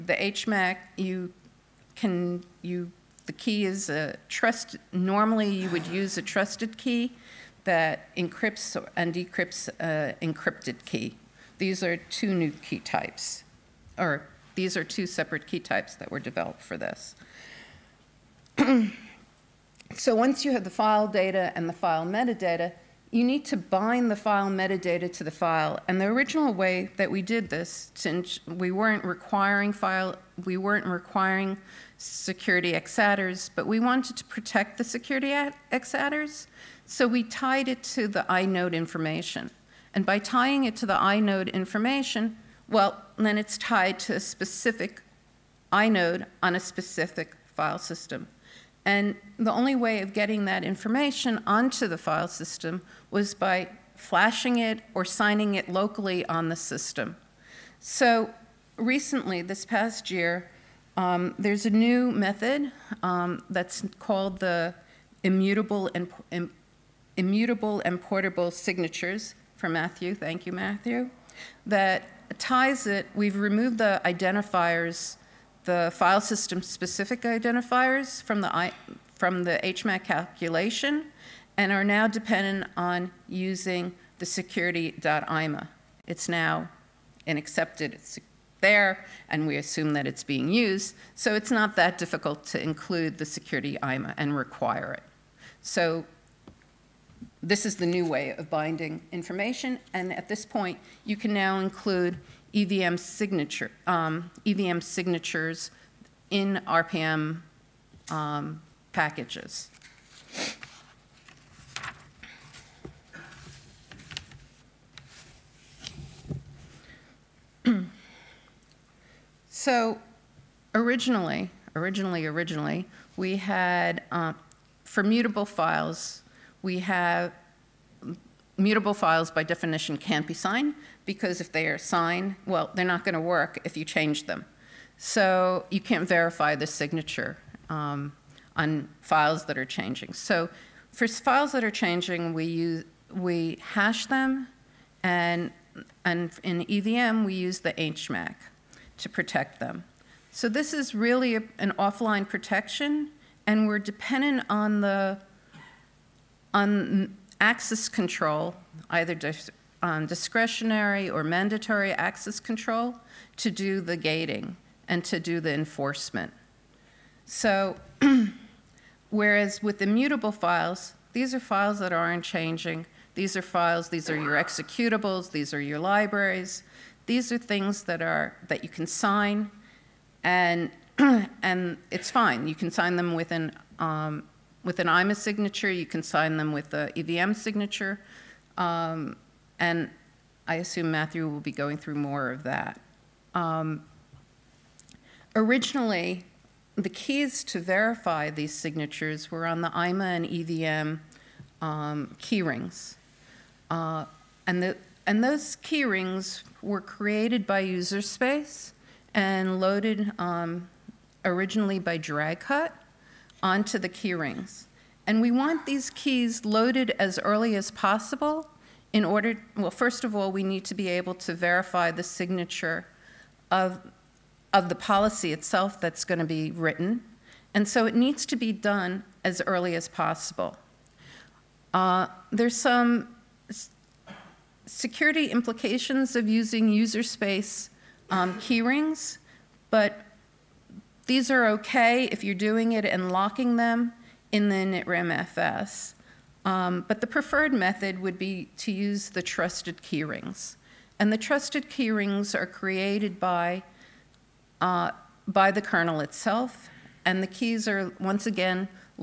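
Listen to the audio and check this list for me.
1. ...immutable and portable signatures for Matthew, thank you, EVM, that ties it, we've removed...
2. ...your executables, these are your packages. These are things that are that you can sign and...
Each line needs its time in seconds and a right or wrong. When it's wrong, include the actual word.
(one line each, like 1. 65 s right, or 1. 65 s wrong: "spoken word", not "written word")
1. 67 s wrong: "Matthew", not "EVM"
2. 174 s wrong: "libraries", not "packages".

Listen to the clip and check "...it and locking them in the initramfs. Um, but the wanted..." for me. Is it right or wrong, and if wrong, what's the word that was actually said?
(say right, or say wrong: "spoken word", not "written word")
wrong: "preferred", not "wanted".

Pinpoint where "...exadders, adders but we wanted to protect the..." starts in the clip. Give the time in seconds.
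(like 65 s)
32 s.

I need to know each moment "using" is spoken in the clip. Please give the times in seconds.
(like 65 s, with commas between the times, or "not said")
83 s, 236 s.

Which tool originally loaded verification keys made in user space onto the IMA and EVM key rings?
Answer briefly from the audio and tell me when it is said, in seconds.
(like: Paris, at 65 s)
Dracut, at 211 s.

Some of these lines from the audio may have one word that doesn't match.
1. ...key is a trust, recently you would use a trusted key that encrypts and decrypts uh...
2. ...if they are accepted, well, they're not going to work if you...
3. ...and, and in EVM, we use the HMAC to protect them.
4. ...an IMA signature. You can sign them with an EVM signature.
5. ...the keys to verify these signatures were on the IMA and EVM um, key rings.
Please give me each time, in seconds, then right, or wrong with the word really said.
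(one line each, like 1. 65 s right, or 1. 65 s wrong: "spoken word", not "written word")
1. 3 s wrong: "normally", not "recently"
2. 131 s wrong: "signed", not "accepted"
3. 145 s right
4. 184 s right
5. 196 s right.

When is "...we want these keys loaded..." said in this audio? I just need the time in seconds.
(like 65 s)
215 s.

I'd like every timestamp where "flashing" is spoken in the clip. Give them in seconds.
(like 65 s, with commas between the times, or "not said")
53 s.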